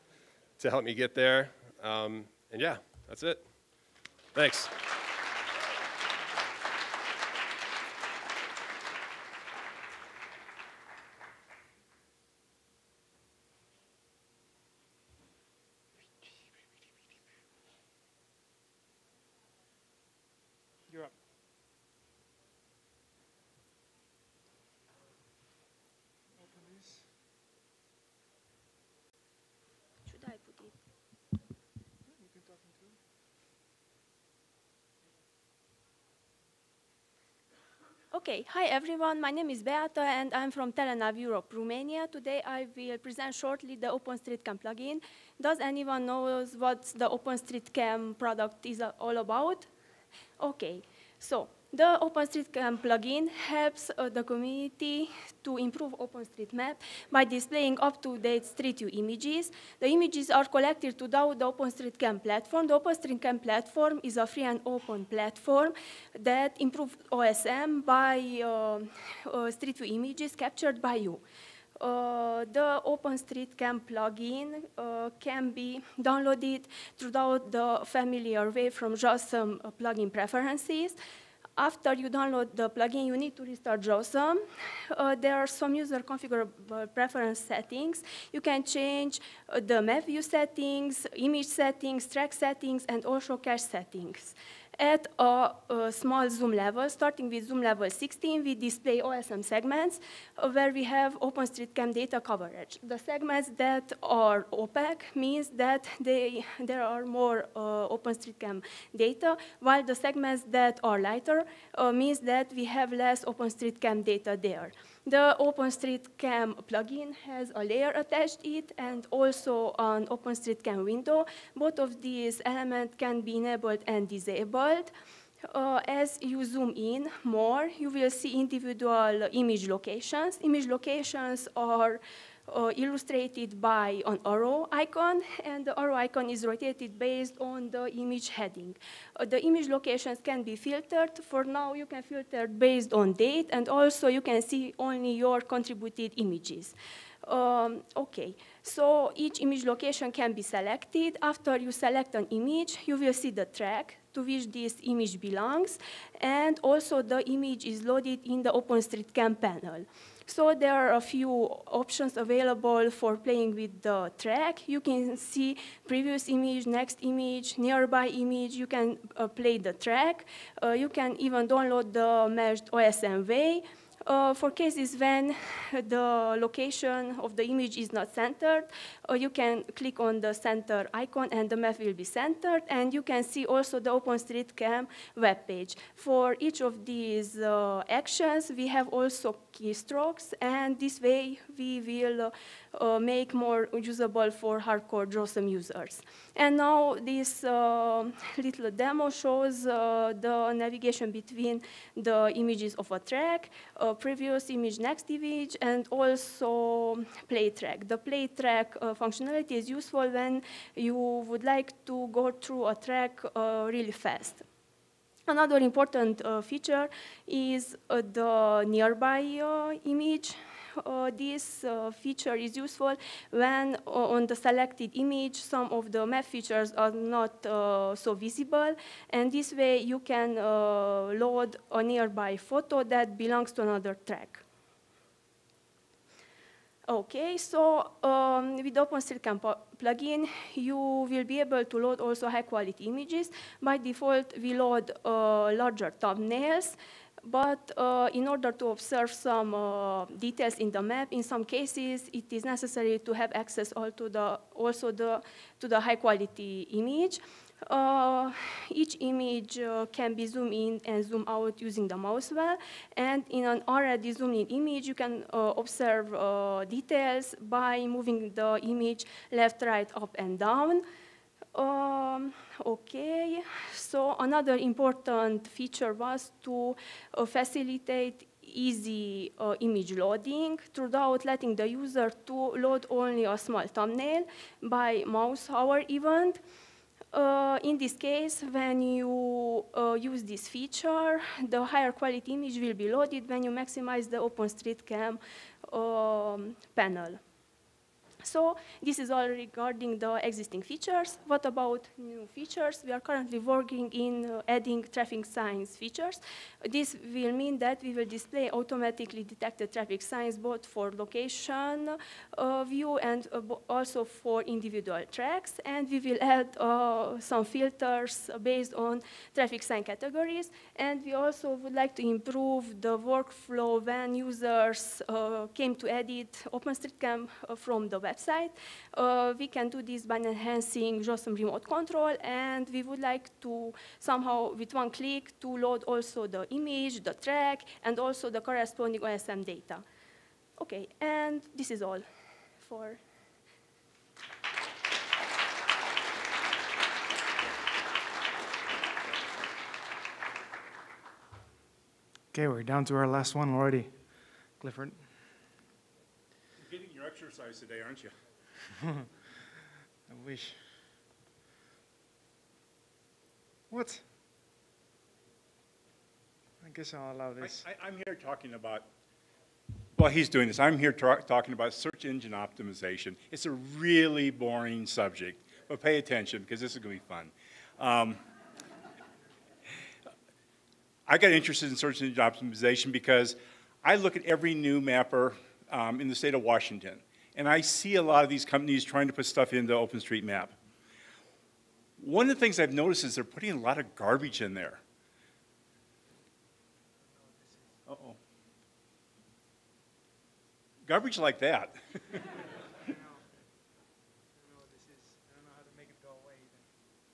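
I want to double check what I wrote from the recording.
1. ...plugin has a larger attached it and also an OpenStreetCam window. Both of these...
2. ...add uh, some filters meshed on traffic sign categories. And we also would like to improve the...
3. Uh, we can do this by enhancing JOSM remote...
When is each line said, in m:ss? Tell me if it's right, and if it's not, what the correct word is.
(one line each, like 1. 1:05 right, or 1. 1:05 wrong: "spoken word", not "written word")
1. 1:56 wrong: "layer", not "larger"
2. 5:16 wrong: "based", not "meshed"
3. 5:28 right.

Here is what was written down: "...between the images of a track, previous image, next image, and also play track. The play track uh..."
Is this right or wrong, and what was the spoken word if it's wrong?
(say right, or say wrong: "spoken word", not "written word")
right.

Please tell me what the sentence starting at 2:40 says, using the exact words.
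So there are a few options available for playing with the track.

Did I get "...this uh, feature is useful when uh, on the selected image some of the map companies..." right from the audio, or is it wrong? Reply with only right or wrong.
wrong.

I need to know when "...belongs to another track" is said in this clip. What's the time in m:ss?
3:53.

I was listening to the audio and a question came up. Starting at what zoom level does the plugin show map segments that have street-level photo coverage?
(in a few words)
16.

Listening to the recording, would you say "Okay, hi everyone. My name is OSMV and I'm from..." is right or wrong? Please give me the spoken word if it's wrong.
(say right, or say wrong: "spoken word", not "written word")
wrong: "Beata", not "OSMV".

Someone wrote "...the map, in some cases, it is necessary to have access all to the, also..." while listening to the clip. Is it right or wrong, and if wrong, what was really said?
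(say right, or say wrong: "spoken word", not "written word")
right.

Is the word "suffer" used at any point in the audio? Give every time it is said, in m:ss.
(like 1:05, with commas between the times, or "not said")
not said.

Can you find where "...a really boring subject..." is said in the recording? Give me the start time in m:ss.
6:13.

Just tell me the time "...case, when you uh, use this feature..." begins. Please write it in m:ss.
4:47.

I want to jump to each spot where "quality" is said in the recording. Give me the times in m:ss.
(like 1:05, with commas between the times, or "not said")
4:02, 4:15, 4:51.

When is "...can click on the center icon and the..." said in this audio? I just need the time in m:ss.
2:59.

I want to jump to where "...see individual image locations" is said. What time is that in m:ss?
2:08.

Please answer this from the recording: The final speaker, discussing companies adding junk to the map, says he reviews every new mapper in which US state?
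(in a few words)
Washington.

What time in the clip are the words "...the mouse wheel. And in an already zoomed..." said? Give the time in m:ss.
4:21.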